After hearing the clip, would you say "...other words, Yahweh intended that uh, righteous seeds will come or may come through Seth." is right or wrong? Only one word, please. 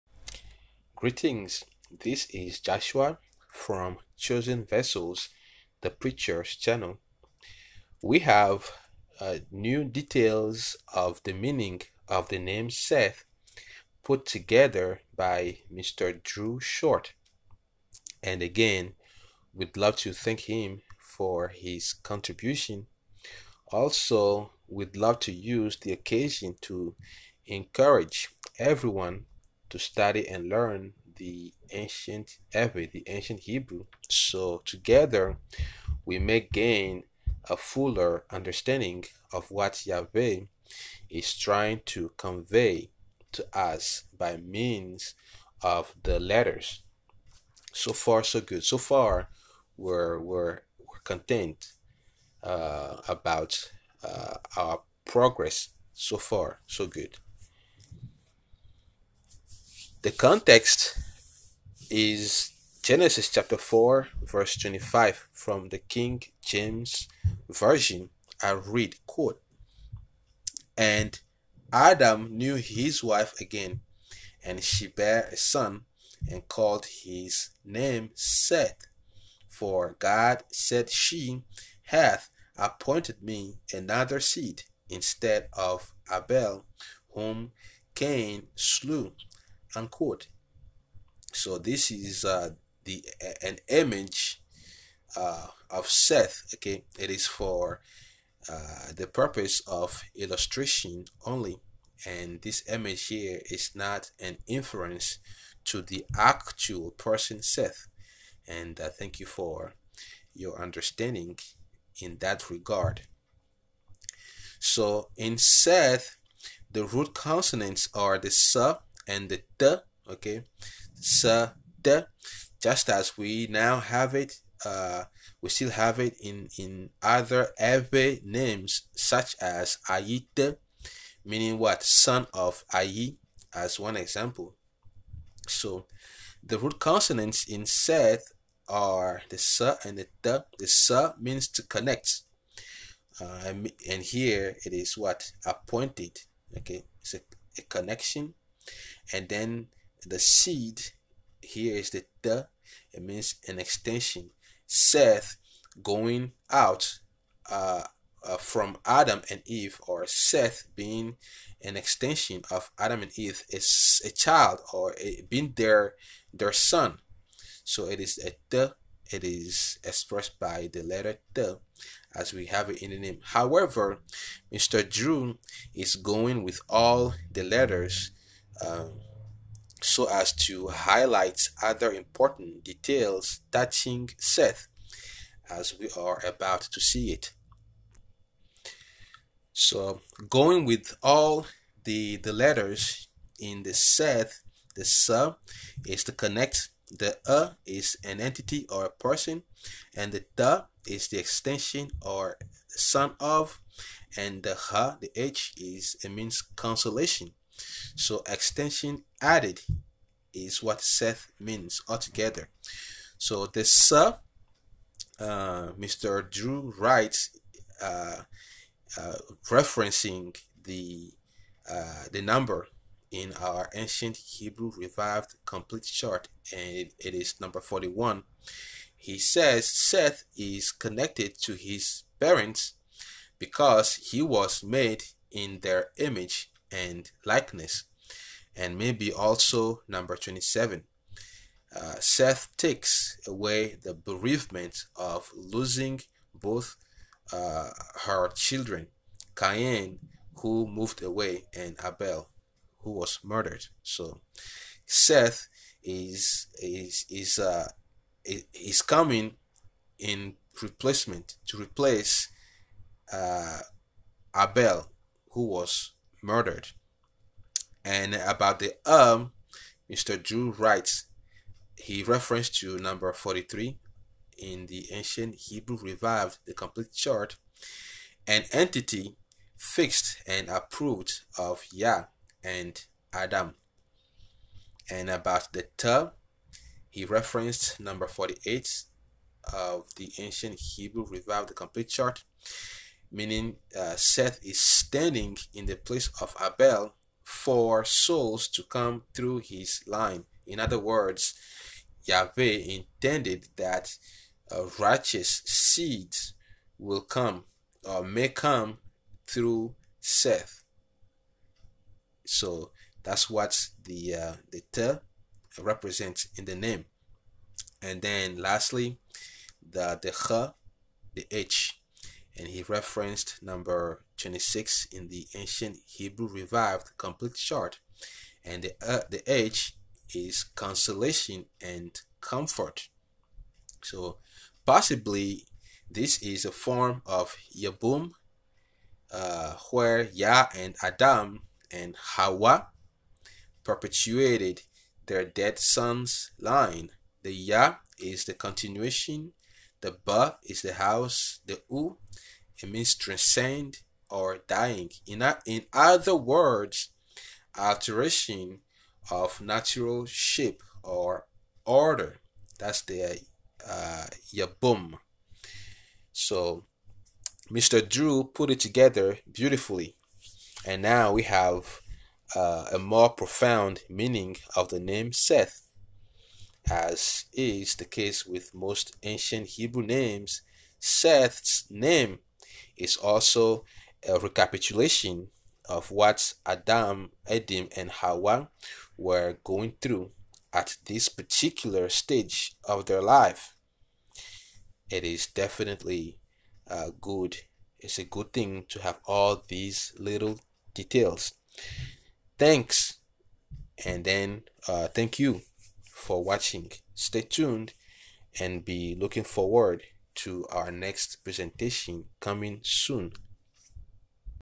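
right.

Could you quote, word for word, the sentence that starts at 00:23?
Also, we'd love to use the occasion to encourage everyone to study and learn the ancient epic, the ancient Hebrew.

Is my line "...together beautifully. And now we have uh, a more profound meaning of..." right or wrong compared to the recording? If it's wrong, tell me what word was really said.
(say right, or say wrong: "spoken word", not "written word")
right.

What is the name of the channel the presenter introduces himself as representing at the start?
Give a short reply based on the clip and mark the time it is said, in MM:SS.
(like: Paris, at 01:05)
Chosen Vessels, at 00:04.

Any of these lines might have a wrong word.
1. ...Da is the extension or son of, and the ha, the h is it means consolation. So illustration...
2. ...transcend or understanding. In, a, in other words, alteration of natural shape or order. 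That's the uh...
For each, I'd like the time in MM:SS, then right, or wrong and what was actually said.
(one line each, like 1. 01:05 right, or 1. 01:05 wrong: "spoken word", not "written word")
1. 03:20 wrong: "extension", not "illustration"
2. 05:52 wrong: "dying", not "understanding".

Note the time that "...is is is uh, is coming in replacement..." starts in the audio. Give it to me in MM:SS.
04:15.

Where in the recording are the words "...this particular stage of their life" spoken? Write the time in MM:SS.
06:30.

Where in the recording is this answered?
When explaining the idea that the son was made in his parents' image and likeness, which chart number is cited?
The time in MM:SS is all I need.
03:47.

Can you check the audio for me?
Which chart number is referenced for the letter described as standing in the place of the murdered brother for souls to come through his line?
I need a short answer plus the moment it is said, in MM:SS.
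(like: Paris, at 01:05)
48, at 04:48.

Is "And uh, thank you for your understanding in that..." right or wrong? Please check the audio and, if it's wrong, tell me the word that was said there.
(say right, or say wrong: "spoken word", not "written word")
right.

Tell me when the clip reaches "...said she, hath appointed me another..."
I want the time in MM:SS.
01:20.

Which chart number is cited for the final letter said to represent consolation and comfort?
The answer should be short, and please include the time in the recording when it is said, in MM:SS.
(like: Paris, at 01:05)
26, at 05:24.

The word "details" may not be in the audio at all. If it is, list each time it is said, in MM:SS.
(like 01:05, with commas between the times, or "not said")
00:09, 03:02, 06:40.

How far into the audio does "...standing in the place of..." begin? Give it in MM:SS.
04:54.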